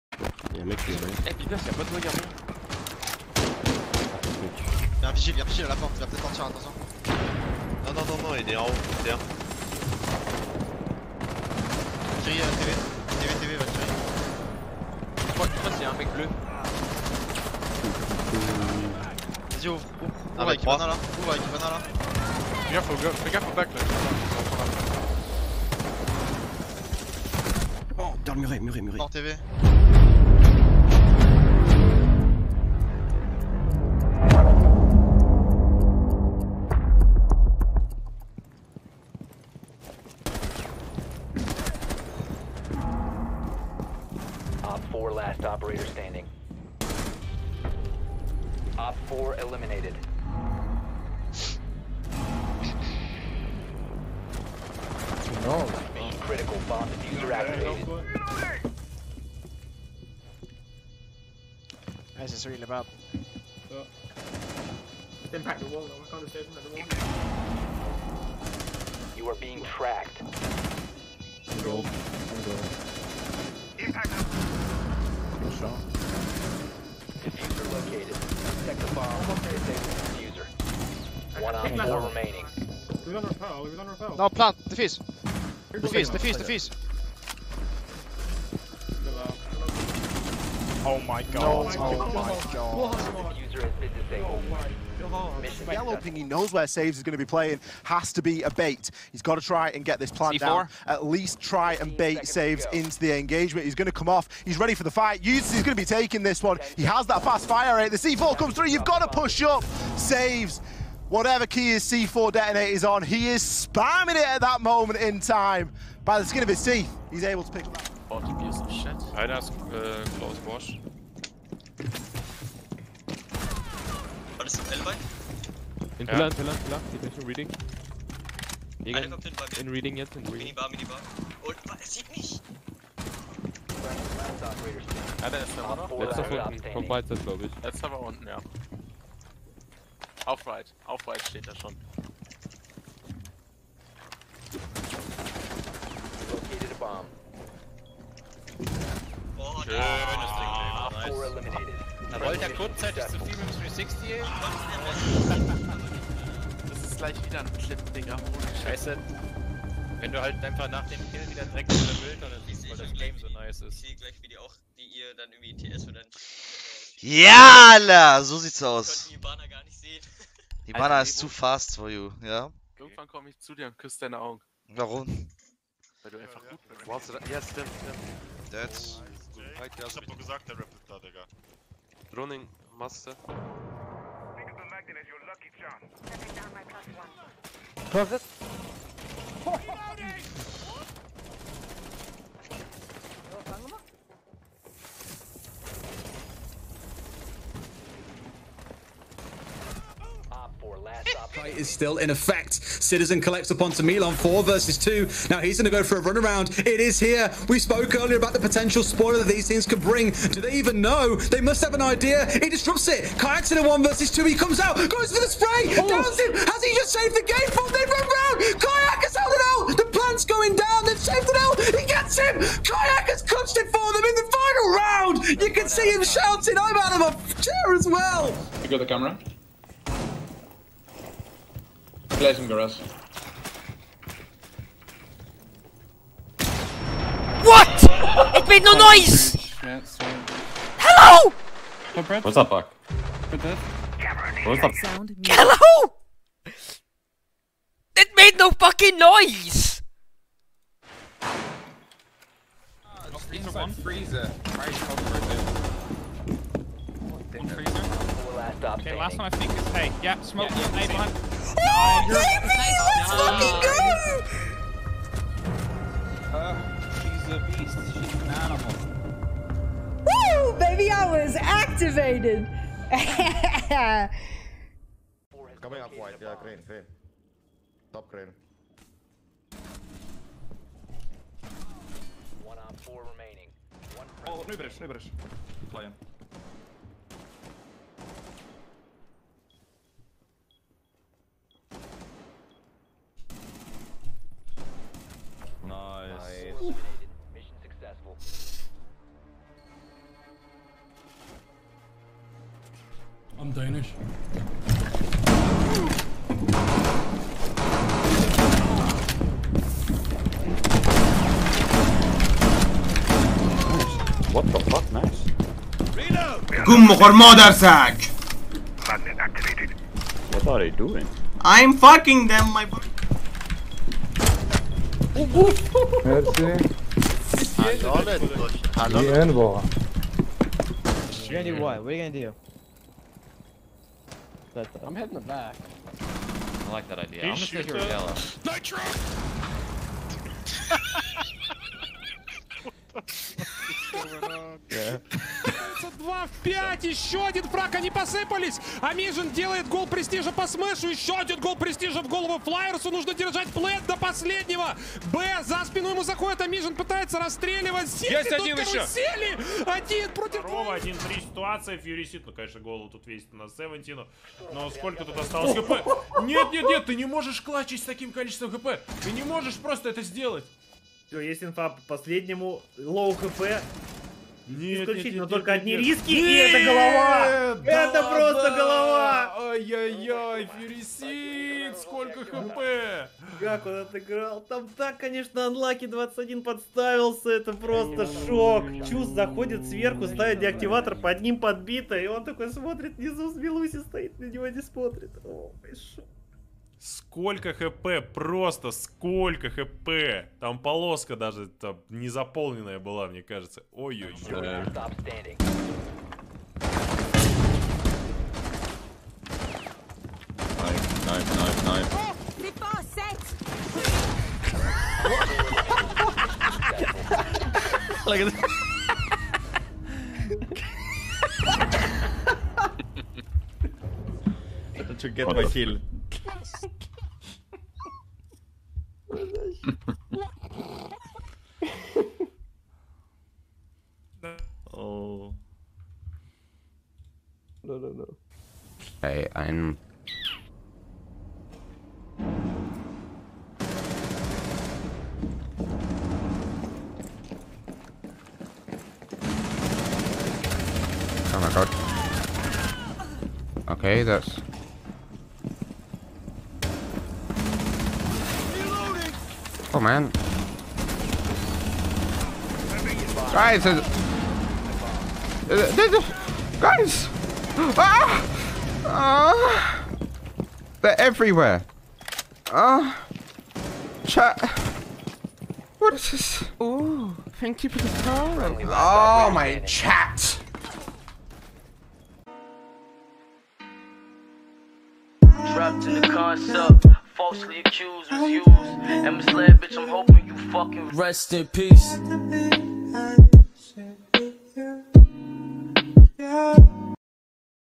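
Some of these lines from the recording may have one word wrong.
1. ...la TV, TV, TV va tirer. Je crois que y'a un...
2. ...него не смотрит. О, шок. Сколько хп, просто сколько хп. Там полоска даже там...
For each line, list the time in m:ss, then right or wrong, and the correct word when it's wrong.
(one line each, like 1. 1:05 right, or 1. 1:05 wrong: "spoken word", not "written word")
1. 0:12 right
2. 6:34 right.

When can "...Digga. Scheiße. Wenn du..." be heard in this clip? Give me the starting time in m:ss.
2:37.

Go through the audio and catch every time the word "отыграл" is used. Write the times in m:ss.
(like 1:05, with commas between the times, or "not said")
6:23.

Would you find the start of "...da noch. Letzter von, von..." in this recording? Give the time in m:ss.
2:15.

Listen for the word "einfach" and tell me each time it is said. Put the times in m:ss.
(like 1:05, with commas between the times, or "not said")
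2:40, 2:56.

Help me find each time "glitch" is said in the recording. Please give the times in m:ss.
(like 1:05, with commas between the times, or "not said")
not said.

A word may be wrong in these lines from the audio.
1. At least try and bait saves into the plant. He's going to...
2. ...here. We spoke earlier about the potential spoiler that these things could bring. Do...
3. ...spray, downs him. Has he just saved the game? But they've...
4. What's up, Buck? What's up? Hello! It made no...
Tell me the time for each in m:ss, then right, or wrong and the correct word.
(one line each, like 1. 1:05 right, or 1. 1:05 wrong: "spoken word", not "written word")
1. 1:40 wrong: "engagement", not "plant"
2. 3:26 right
3. 3:35 right
4. 4:02 right.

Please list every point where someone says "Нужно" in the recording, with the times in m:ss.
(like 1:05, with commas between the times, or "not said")
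5:52.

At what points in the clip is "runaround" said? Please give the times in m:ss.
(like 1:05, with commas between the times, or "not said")
3:26.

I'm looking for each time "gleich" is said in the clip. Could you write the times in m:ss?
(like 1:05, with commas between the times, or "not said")
2:36, 2:43.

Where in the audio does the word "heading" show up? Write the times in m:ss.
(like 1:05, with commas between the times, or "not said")
5:34.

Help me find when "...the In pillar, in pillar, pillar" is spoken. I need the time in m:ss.
2:04.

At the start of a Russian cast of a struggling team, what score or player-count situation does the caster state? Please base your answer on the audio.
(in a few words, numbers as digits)
2 vs 5.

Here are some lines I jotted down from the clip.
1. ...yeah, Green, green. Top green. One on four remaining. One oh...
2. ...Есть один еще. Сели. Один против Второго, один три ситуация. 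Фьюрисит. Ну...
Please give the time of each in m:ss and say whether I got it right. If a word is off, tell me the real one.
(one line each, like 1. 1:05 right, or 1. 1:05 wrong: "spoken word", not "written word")
1. 4:36 right
2. 5:58 right.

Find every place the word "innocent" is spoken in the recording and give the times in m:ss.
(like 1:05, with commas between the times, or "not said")
not said.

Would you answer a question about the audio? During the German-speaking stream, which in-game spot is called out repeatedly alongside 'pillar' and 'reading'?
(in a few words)
Minibar.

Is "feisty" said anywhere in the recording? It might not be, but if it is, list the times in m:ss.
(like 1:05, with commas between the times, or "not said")
not said.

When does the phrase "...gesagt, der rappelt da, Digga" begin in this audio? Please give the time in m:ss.
3:00.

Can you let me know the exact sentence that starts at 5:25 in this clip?
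مرسی حلالت باش حلالت این واقعا You're gonna do what?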